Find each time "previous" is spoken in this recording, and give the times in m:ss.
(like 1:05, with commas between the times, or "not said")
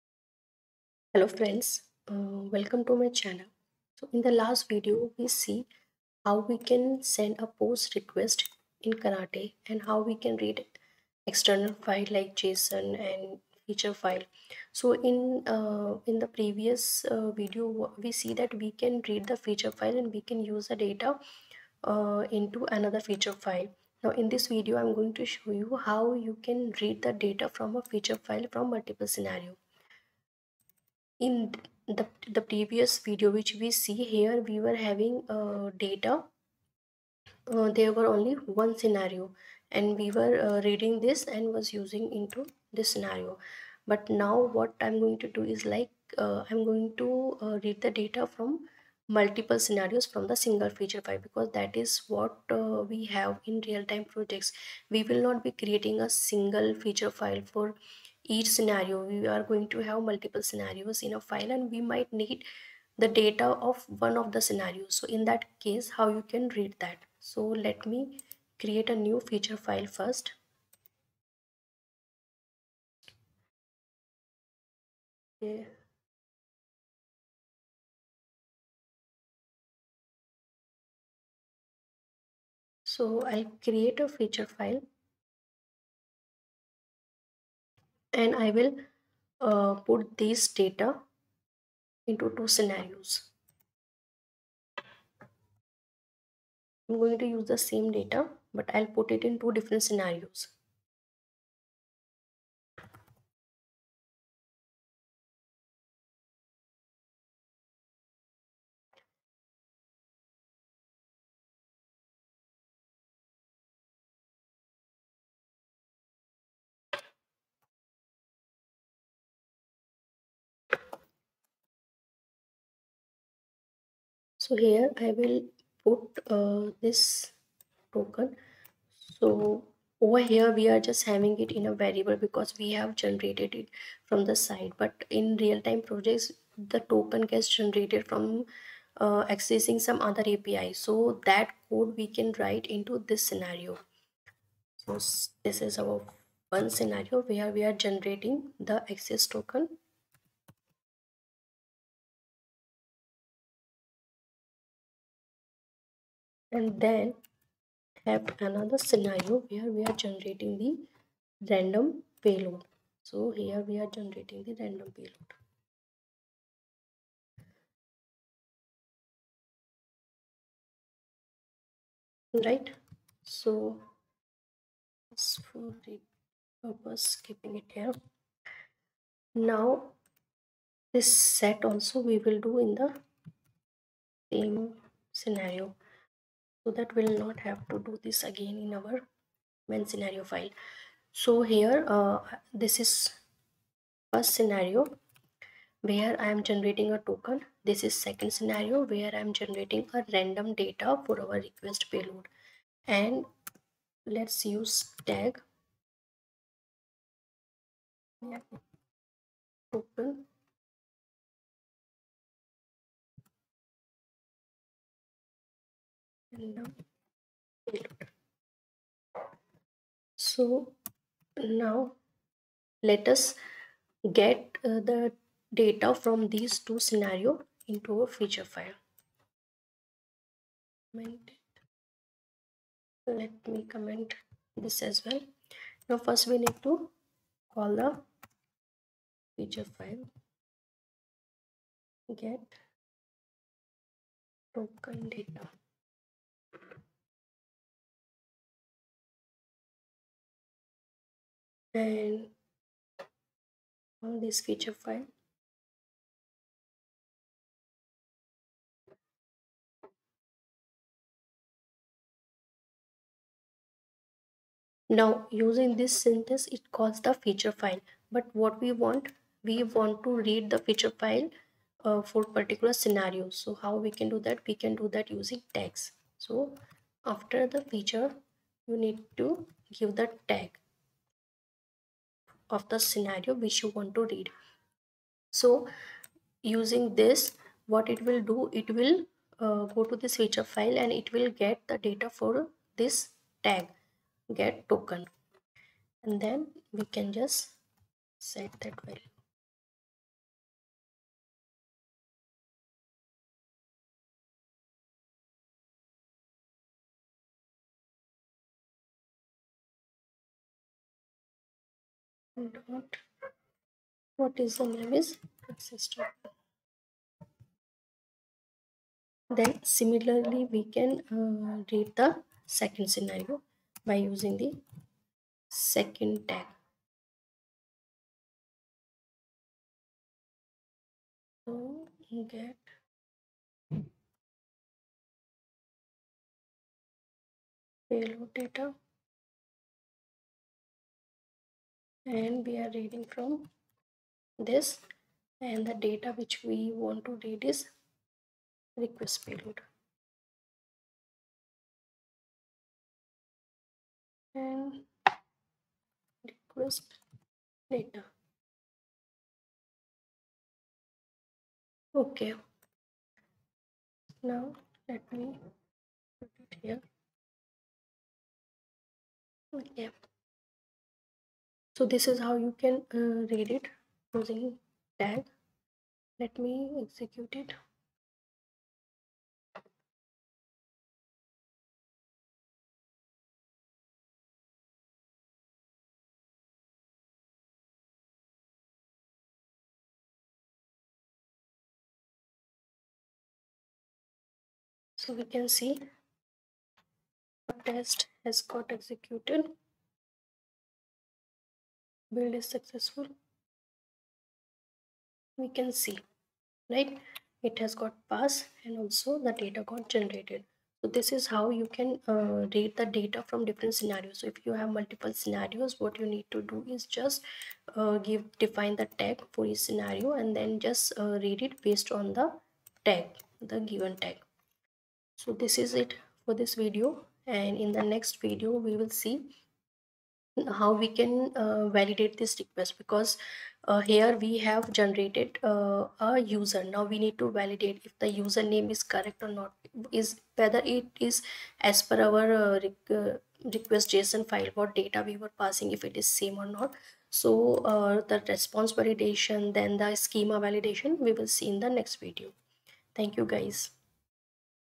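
0:16, 0:32.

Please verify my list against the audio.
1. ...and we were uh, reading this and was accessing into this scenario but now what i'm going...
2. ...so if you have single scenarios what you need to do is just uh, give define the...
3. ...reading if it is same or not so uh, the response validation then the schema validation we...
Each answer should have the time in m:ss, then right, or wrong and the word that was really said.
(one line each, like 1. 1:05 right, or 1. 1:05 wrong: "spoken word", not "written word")
1. 0:39 wrong: "using", not "accessing"
2. 6:54 wrong: "multiple", not "single"
3. 7:25 wrong: "passing", not "reading".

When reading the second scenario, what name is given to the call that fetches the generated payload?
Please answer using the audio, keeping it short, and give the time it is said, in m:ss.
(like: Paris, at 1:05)
get payload data, at 5:32.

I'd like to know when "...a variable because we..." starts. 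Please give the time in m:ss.
2:11.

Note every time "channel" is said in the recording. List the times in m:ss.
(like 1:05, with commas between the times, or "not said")
0:03.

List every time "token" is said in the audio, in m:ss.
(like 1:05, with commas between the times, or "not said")
2:07, 2:16, 2:29, 3:16, 3:29, 4:04, 4:54, 5:15.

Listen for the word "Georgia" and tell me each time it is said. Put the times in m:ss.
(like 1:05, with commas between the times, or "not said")
not said.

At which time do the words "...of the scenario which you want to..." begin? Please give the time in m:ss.
4:42.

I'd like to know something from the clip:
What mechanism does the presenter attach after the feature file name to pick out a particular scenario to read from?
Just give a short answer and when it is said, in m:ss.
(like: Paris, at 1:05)
tags, at 4:35.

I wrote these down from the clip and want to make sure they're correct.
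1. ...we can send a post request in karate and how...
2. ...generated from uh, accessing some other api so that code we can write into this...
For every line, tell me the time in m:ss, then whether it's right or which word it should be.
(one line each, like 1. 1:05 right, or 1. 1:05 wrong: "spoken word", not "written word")
1. 0:06 right
2. 2:17 right.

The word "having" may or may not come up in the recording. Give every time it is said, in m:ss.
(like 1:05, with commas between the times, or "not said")
0:34, 2:11.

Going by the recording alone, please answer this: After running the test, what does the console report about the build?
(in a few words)
build is successful.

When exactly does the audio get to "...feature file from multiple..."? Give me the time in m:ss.
0:27.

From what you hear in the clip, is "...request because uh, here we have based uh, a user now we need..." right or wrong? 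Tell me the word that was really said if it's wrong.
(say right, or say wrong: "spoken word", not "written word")
wrong: "generated", not "based".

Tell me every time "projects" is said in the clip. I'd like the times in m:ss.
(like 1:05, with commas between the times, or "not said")
0:54, 2:15.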